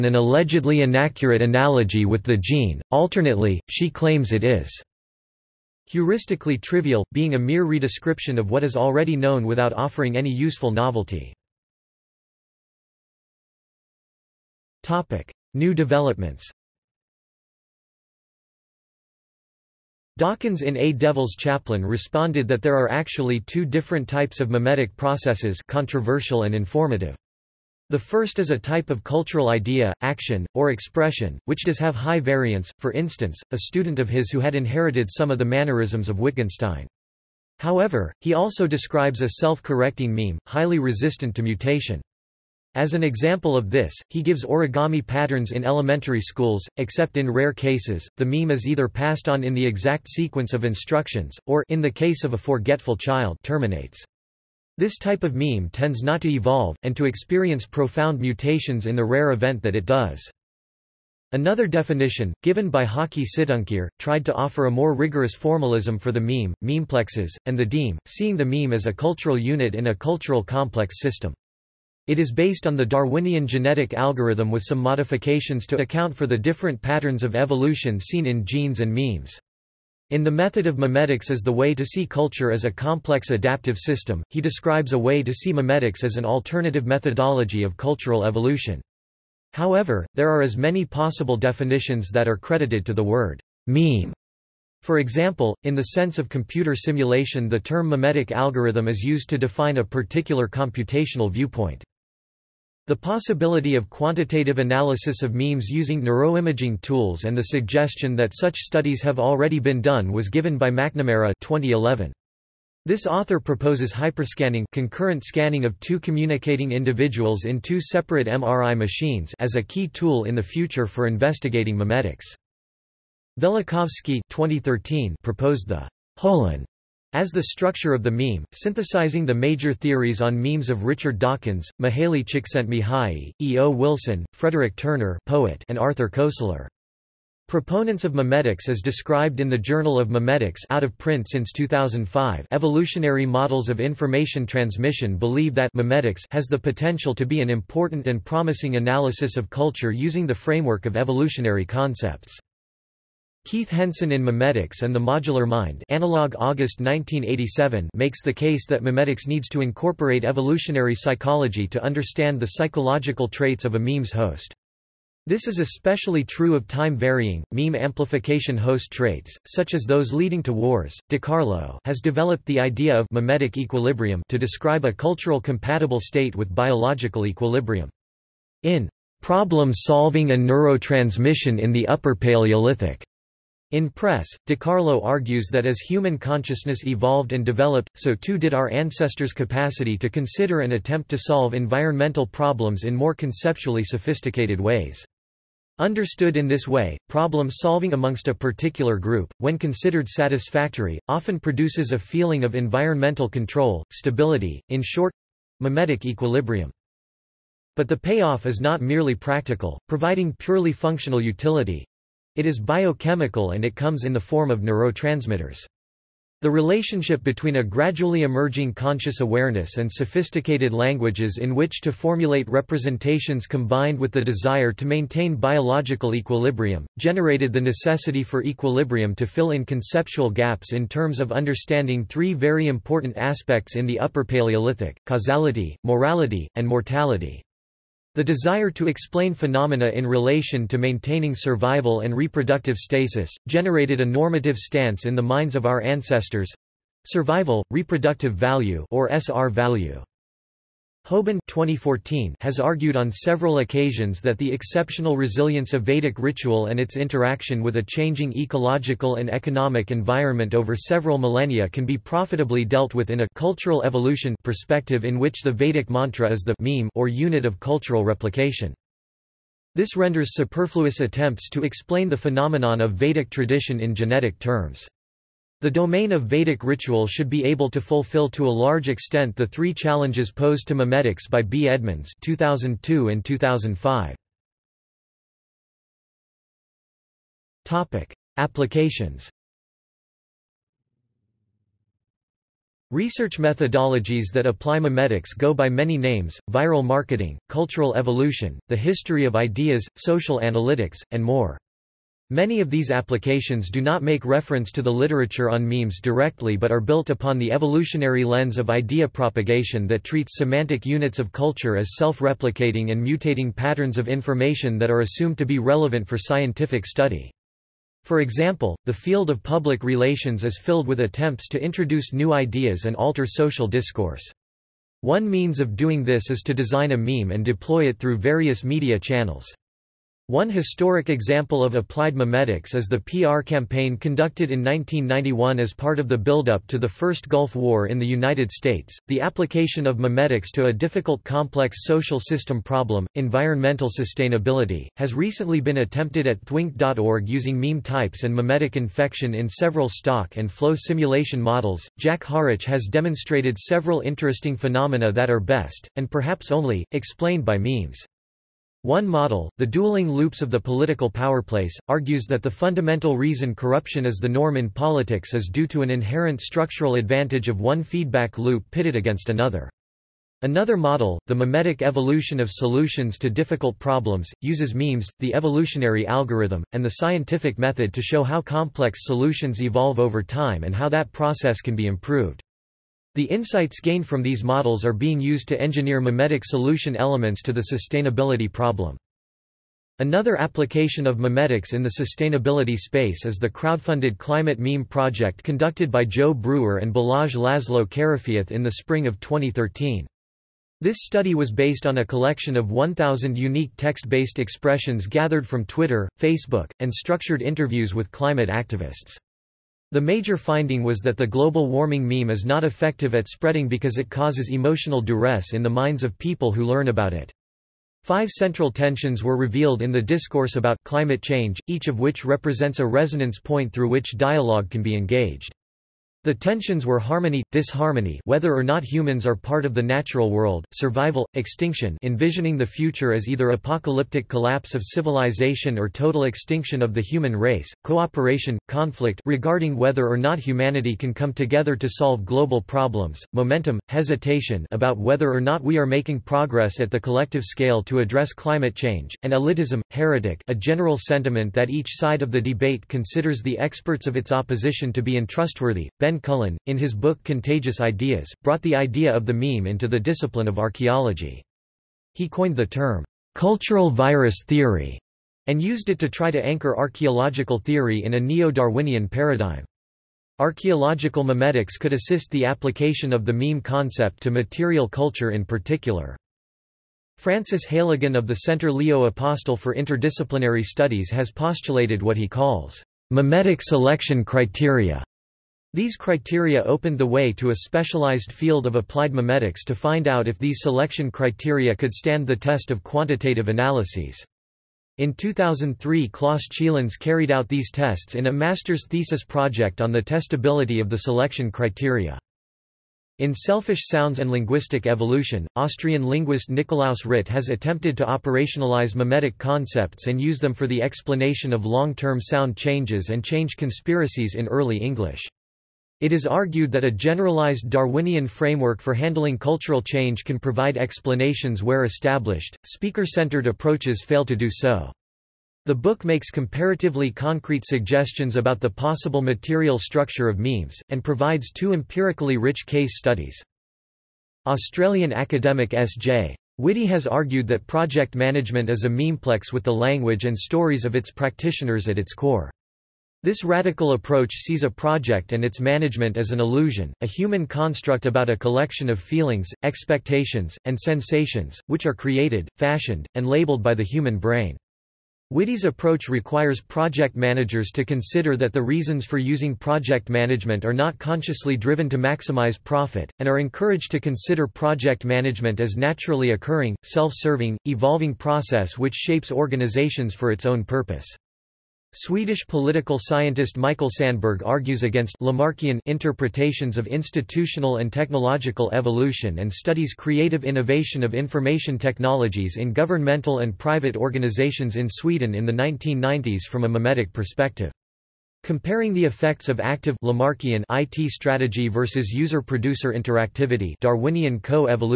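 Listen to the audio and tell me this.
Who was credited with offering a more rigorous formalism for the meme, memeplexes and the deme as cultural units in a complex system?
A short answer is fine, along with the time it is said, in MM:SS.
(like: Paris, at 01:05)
Hokky Situngkir, at 01:02.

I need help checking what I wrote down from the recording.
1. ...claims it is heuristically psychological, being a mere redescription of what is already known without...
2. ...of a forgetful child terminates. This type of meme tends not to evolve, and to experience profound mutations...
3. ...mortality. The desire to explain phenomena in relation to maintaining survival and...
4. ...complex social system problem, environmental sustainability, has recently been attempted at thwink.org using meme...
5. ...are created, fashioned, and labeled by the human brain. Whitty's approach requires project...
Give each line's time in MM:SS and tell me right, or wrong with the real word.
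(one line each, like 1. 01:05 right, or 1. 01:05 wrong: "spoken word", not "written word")
1. 00:03 wrong: "trivial", not "psychological"
2. 00:52 right
3. 03:56 right
4. 05:41 right
5. 09:11 right.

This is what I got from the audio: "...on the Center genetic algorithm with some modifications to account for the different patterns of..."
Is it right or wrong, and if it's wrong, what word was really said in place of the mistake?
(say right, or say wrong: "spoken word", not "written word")
wrong: "Darwinian", not "Center".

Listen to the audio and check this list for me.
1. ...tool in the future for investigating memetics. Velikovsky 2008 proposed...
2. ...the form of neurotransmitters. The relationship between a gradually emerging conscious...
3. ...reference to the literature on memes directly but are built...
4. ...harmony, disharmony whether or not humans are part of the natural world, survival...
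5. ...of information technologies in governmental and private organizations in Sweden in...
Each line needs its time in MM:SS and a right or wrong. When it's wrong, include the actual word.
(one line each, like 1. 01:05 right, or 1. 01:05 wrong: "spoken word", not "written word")
1. 01:59 wrong: "2013", not "2008"
2. 03:34 right
3. 05:04 right
4. 07:07 right
5. 09:41 right.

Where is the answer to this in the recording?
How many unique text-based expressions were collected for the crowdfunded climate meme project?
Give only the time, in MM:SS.
06:42.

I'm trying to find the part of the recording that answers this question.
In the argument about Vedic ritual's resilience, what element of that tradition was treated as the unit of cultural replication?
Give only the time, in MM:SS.
04:25.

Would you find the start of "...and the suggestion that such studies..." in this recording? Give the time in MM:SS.
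01:47.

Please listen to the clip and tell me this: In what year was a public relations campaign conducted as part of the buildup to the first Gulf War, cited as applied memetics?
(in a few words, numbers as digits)
1991.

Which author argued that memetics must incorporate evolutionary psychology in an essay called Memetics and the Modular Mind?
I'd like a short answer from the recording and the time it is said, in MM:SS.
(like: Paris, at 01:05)
Keith Henson, at 02:33.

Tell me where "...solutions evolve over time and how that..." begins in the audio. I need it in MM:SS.
06:19.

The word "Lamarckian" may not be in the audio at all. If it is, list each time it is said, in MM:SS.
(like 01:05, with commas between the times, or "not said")
09:35, 09:50.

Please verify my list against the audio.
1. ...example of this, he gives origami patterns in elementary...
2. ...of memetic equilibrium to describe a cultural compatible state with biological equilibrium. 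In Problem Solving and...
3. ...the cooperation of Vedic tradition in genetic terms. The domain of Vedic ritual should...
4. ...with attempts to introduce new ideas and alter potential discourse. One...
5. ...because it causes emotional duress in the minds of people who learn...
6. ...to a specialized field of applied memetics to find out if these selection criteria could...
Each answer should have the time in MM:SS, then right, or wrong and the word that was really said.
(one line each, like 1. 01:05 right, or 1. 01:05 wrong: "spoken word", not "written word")
1. 00:43 right
2. 02:52 right
3. 04:32 wrong: "phenomenon", not "cooperation"
4. 05:20 wrong: "social", not "potential"
5. 06:53 right
6. 08:07 right.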